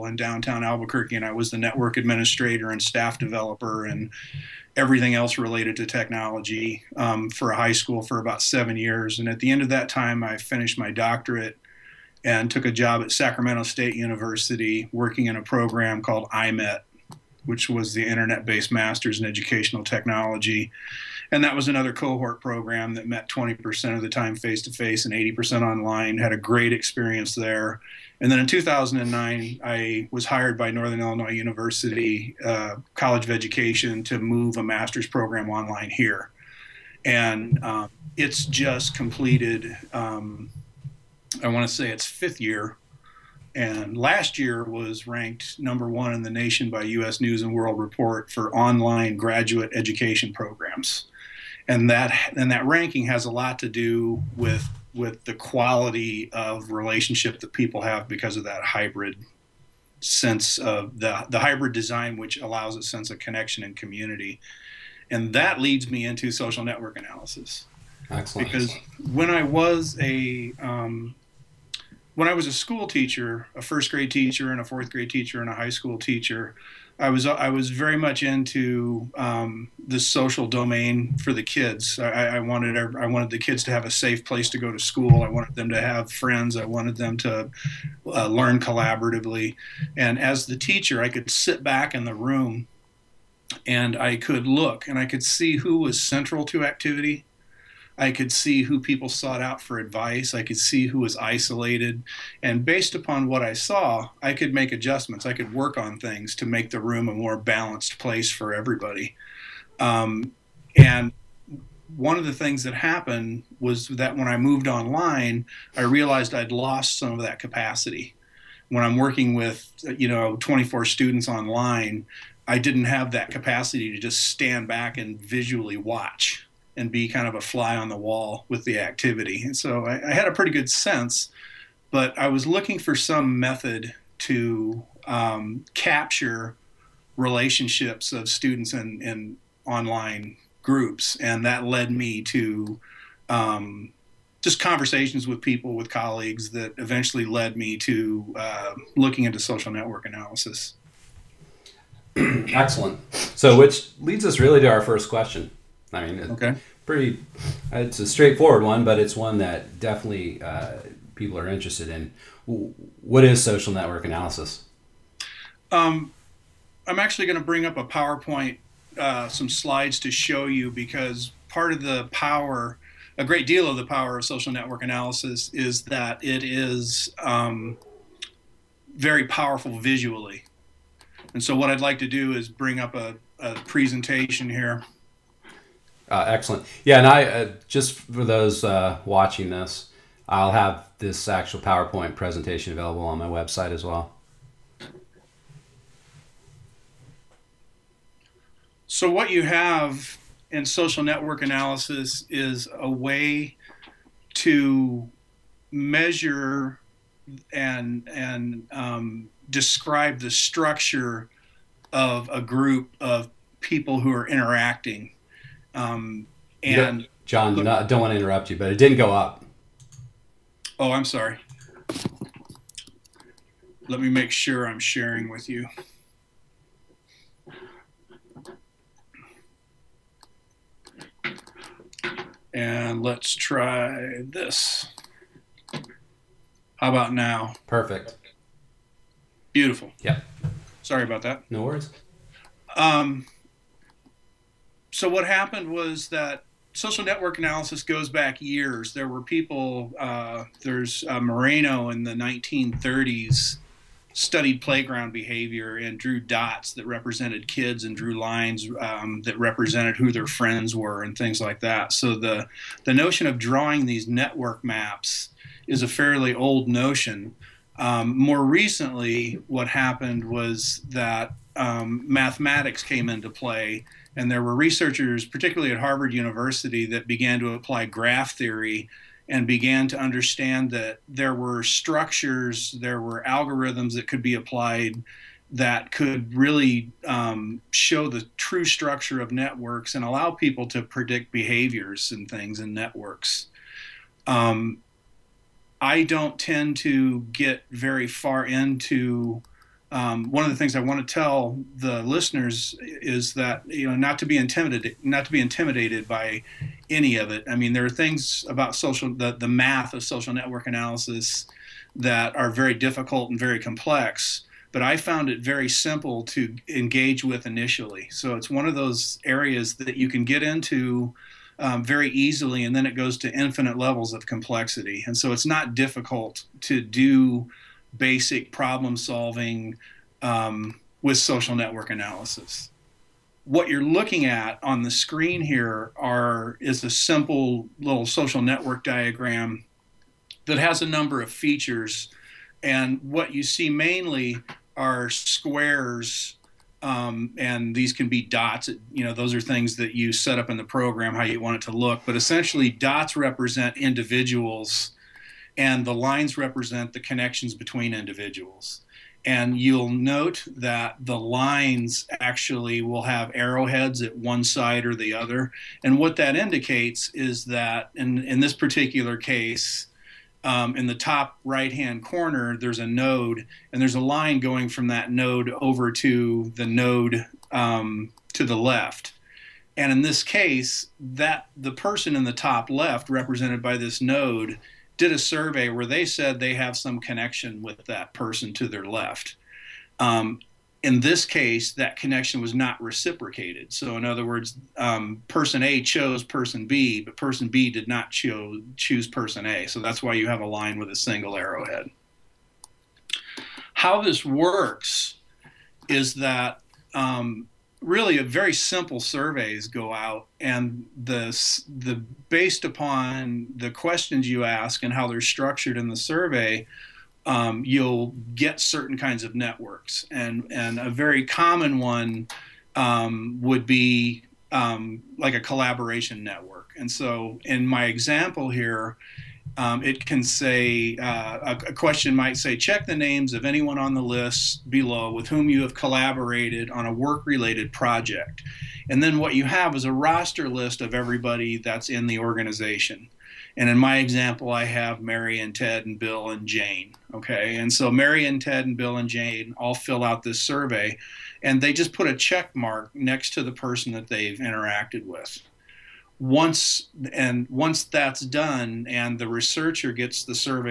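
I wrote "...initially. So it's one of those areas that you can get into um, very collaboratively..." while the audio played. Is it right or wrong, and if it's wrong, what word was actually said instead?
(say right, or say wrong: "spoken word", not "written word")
wrong: "easily", not "collaboratively".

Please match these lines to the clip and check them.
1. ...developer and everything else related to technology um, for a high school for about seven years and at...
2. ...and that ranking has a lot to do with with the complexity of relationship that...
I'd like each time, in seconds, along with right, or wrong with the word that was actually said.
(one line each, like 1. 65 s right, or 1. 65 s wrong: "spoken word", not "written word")
1. 3 s right
2. 52 s wrong: "quality", not "complexity".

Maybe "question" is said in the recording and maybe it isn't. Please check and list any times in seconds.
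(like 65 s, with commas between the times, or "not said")
155 s, 413 s, 431 s.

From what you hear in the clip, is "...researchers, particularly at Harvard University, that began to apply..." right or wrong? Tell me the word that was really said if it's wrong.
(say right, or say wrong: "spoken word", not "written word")
right.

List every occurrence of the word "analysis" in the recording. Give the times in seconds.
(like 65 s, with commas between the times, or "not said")
66 s, 150 s, 164 s, 174 s, 201 s, 247 s, 310 s, 331 s.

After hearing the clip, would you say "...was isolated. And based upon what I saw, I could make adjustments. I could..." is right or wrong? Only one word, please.
right.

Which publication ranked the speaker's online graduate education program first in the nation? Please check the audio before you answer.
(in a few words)
U.S. News and World Report.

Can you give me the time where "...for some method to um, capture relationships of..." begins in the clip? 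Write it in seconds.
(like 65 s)
132 s.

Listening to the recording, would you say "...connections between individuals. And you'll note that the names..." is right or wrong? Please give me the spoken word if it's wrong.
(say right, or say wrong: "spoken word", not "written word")
wrong: "lines", not "names".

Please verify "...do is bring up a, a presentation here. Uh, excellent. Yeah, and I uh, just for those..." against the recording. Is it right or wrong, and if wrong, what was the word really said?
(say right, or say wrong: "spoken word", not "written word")
right.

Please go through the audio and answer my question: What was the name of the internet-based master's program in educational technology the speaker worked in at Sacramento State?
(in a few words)
IMET.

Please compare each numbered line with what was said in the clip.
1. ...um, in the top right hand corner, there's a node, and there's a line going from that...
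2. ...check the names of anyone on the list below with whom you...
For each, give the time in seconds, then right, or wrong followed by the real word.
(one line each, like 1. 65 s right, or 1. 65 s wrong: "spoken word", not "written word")
1. 370 s right
2. 432 s right.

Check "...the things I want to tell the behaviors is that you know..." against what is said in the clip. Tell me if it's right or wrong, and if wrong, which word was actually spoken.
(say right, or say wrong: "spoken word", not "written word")
wrong: "listeners", not "behaviors".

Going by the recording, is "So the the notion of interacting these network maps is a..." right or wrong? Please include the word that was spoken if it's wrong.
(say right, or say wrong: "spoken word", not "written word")
wrong: "drawing", not "interacting".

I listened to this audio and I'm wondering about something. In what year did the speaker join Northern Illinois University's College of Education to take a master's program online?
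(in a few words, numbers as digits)
2009.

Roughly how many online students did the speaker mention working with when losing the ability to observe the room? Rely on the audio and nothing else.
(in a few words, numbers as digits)
24.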